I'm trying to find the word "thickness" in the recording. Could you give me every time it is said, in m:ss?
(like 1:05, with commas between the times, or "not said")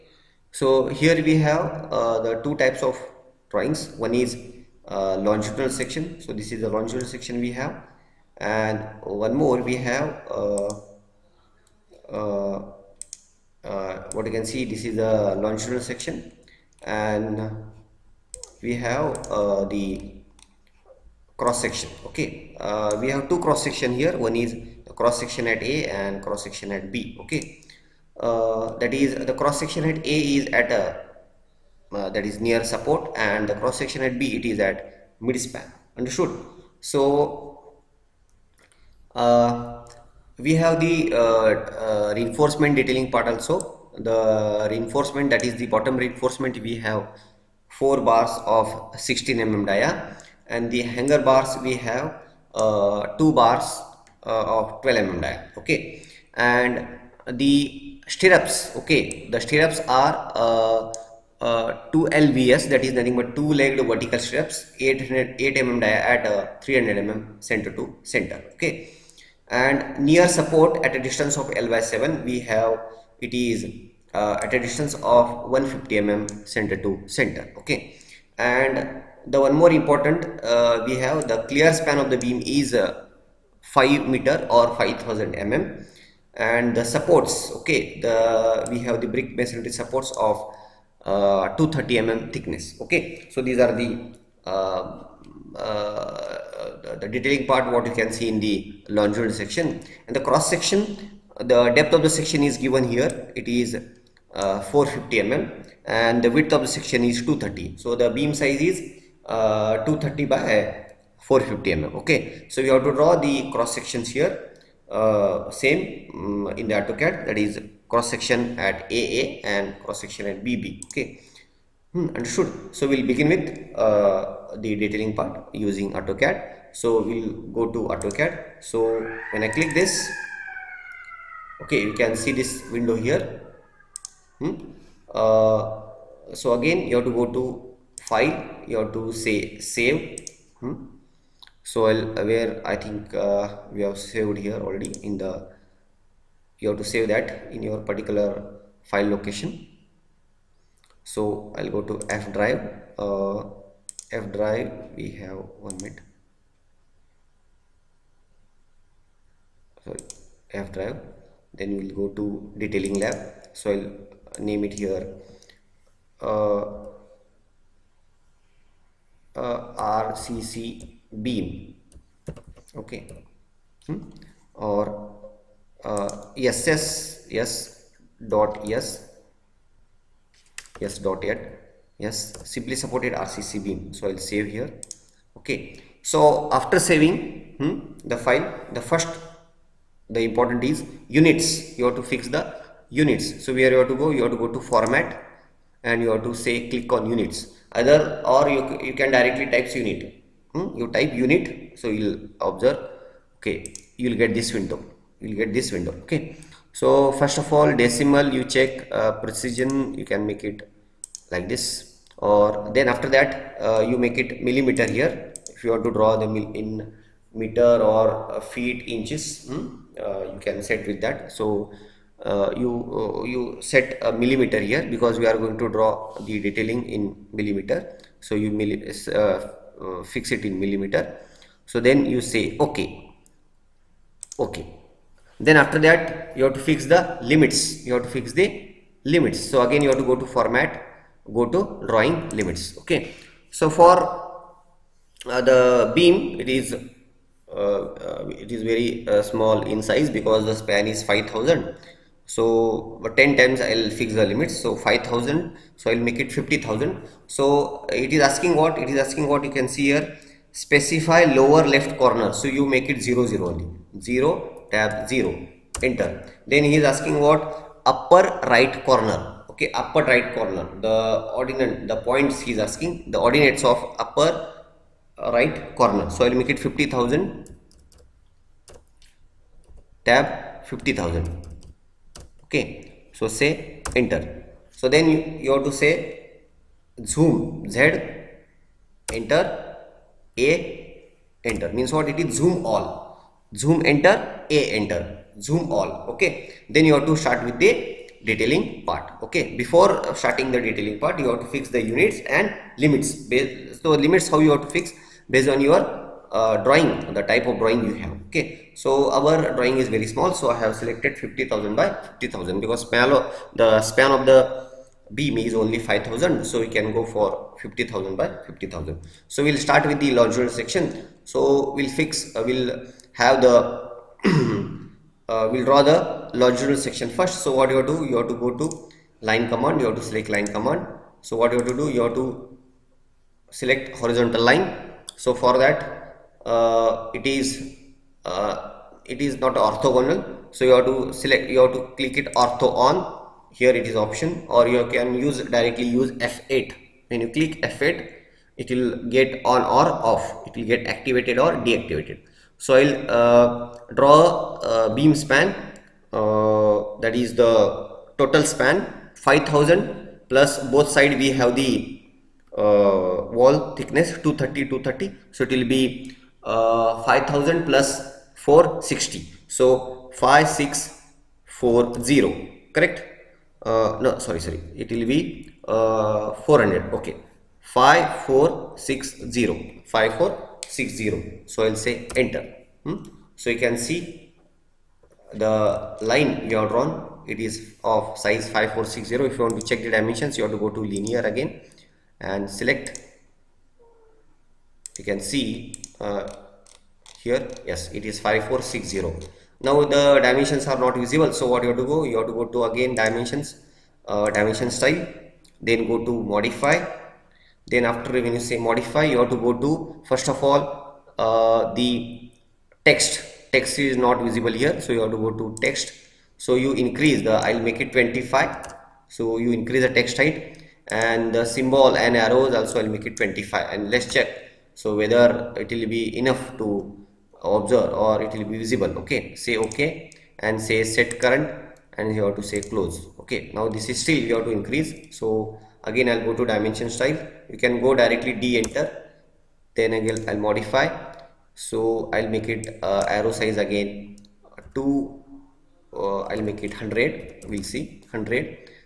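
1:32, 6:03.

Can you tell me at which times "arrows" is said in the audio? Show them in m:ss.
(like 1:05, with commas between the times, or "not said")
7:02, 7:23.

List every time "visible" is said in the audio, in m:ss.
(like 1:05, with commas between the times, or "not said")
6:41, 6:54, 7:08.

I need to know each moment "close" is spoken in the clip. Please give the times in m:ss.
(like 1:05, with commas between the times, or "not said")
7:12.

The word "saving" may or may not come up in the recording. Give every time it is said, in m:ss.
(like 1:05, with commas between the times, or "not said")
3:06.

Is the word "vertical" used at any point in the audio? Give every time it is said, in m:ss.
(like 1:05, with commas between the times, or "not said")
1:03.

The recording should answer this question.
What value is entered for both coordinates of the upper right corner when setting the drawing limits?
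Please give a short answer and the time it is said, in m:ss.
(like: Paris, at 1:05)
50,000, at 4:36.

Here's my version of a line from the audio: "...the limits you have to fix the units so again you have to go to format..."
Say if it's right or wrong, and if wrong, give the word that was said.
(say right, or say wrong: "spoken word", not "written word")
wrong: "limits", not "units".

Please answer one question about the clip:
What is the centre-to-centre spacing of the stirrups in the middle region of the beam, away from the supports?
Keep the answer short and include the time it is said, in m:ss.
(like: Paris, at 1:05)
300 mm, at 1:06.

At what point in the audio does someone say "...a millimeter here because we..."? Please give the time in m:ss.
3:44.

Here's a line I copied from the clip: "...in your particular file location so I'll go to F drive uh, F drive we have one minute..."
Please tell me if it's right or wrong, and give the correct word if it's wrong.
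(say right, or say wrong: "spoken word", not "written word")
right.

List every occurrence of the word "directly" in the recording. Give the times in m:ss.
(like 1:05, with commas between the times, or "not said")
3:19, 5:45, 7:17.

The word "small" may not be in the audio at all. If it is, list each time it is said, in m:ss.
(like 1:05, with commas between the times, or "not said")
4:09, 5:10.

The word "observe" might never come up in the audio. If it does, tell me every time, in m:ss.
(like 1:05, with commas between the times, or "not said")
3:22, 7:07.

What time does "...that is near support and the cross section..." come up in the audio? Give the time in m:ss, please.
0:32.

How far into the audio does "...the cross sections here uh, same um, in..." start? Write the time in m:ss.
1:53.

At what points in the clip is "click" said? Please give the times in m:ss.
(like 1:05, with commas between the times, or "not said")
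2:09, 3:16, 5:41, 5:47.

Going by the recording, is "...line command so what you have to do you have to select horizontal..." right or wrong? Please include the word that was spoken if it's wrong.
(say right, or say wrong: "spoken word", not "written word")
right.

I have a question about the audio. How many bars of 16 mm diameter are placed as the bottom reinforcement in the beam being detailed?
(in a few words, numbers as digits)
4.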